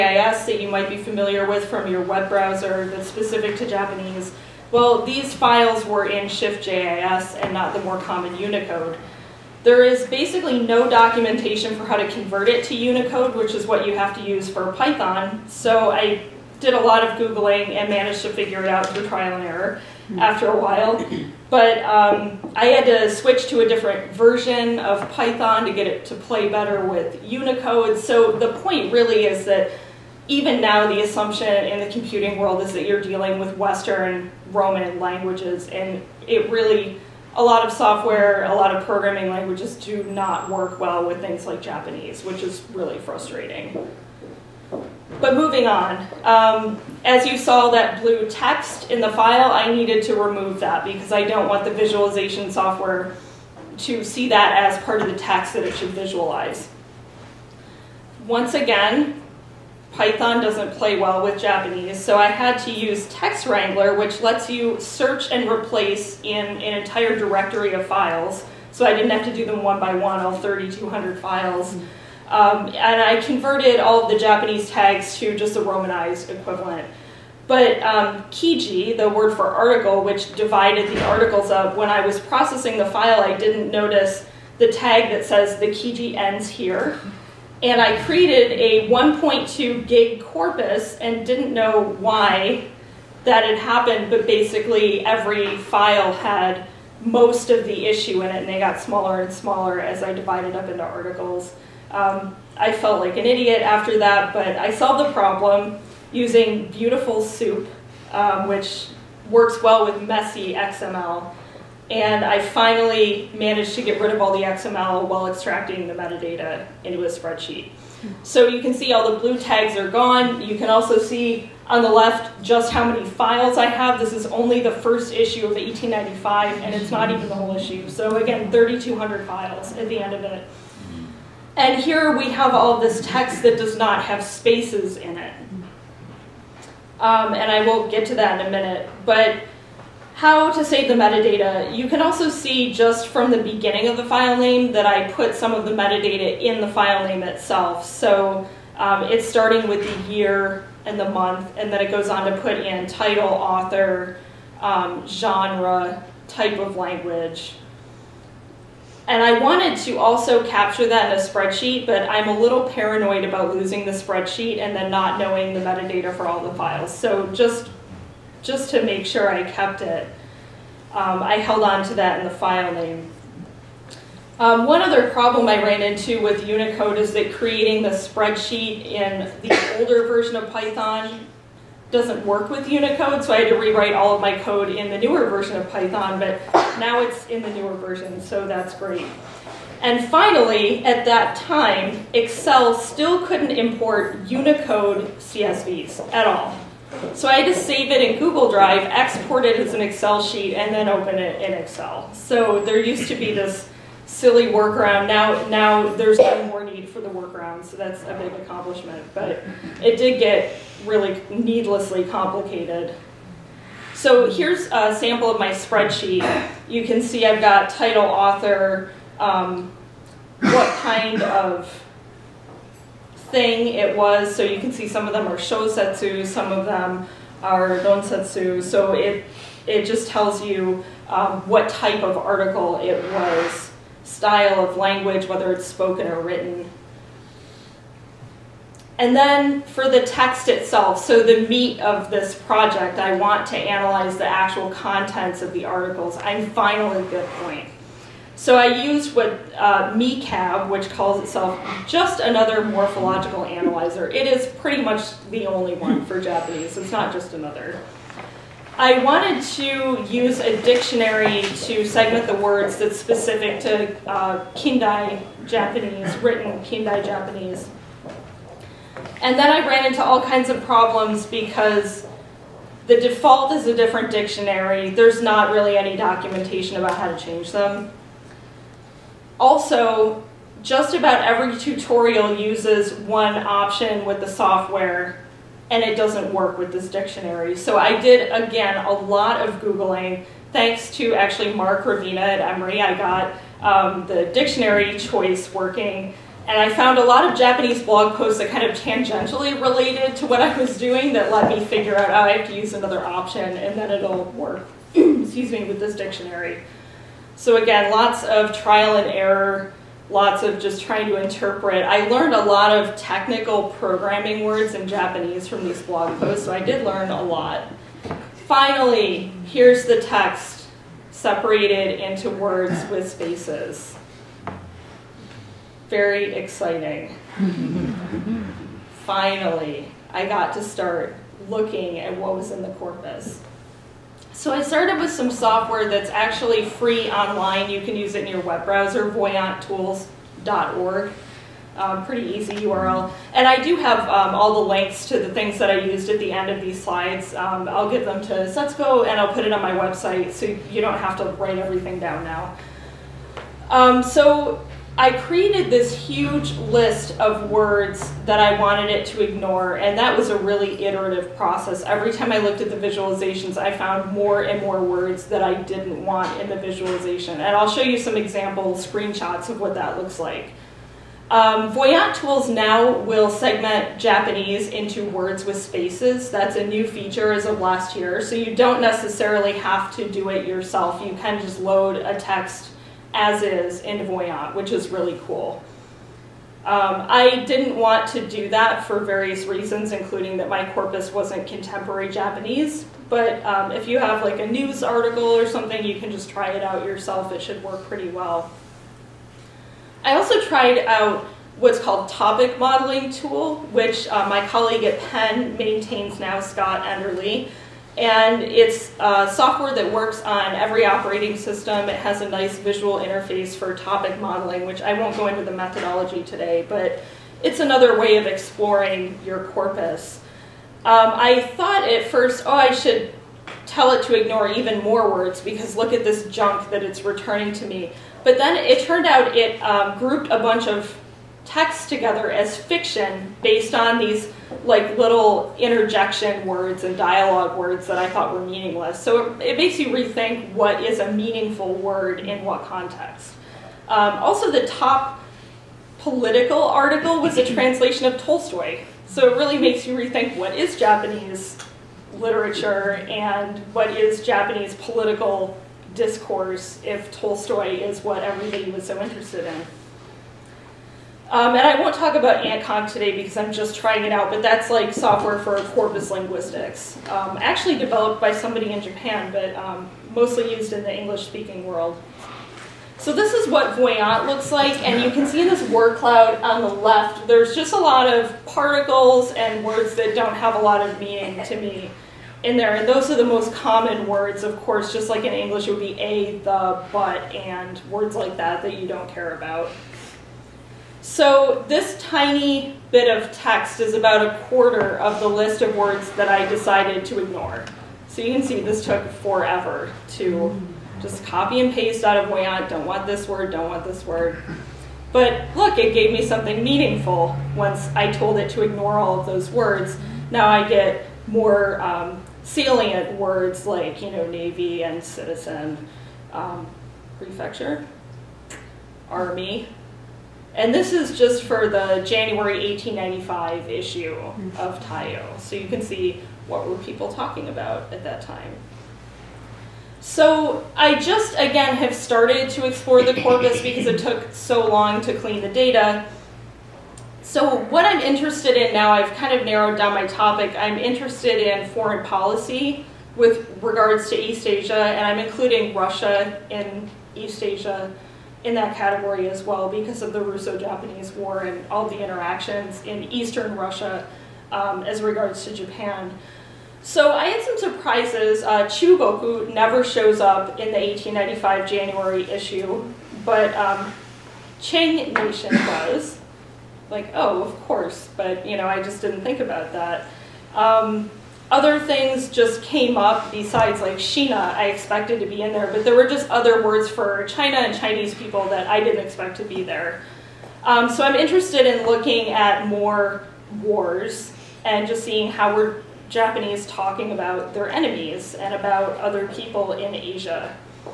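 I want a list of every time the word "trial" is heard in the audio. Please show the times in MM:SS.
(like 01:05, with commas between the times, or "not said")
00:19, 05:08.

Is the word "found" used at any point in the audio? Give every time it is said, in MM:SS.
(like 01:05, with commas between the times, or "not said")
04:56, 06:03.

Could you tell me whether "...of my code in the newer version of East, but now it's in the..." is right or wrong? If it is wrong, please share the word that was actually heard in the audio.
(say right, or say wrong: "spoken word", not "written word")
wrong: "Python", not "East".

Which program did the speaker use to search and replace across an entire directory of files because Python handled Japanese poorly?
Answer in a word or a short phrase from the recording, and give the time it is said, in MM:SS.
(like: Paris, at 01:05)
Text Wrangler, at 01:03.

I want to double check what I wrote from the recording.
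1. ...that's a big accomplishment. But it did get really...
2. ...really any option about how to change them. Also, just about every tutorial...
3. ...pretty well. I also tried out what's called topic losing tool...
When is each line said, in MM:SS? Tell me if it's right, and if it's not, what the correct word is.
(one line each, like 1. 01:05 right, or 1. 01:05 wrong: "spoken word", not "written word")
1. 03:27 right
2. 04:35 wrong: "documentation", not "option"
3. 06:37 wrong: "modeling", not "losing".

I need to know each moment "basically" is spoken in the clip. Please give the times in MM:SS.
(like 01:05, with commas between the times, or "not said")
00:10, 01:34.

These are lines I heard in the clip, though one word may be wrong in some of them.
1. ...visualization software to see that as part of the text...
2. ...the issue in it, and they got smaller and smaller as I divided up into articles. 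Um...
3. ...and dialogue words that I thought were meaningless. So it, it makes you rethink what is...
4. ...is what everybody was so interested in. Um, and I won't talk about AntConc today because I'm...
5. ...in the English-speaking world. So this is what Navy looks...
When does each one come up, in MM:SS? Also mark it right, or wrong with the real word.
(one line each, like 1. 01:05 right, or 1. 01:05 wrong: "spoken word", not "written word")
1. 00:51 right
2. 01:37 right
3. 07:16 right
4. 07:37 right
5. 07:50 wrong: "Voyant", not "Navy".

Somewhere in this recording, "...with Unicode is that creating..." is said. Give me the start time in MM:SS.
02:56.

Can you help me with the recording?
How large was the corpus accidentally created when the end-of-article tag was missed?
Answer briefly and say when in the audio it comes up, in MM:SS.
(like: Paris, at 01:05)
1.2 gig, at 01:28.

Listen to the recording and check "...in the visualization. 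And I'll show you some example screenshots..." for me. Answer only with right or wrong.
right.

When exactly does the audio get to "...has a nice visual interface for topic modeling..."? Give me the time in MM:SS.
06:51.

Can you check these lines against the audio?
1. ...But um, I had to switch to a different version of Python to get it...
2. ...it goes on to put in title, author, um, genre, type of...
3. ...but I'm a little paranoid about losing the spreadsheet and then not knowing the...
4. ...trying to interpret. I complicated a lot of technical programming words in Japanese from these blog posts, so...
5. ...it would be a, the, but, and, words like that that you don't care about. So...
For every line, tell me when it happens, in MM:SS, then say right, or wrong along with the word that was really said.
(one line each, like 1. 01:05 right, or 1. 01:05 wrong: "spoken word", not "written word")
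1. 00:21 right
2. 02:31 right
3. 02:41 right
4. 05:10 wrong: "learned", not "complicated"
5. 08:05 right.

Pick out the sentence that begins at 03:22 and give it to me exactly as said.
So there used to be this silly workaround.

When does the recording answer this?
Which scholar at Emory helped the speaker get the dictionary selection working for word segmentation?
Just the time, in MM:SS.
04:51.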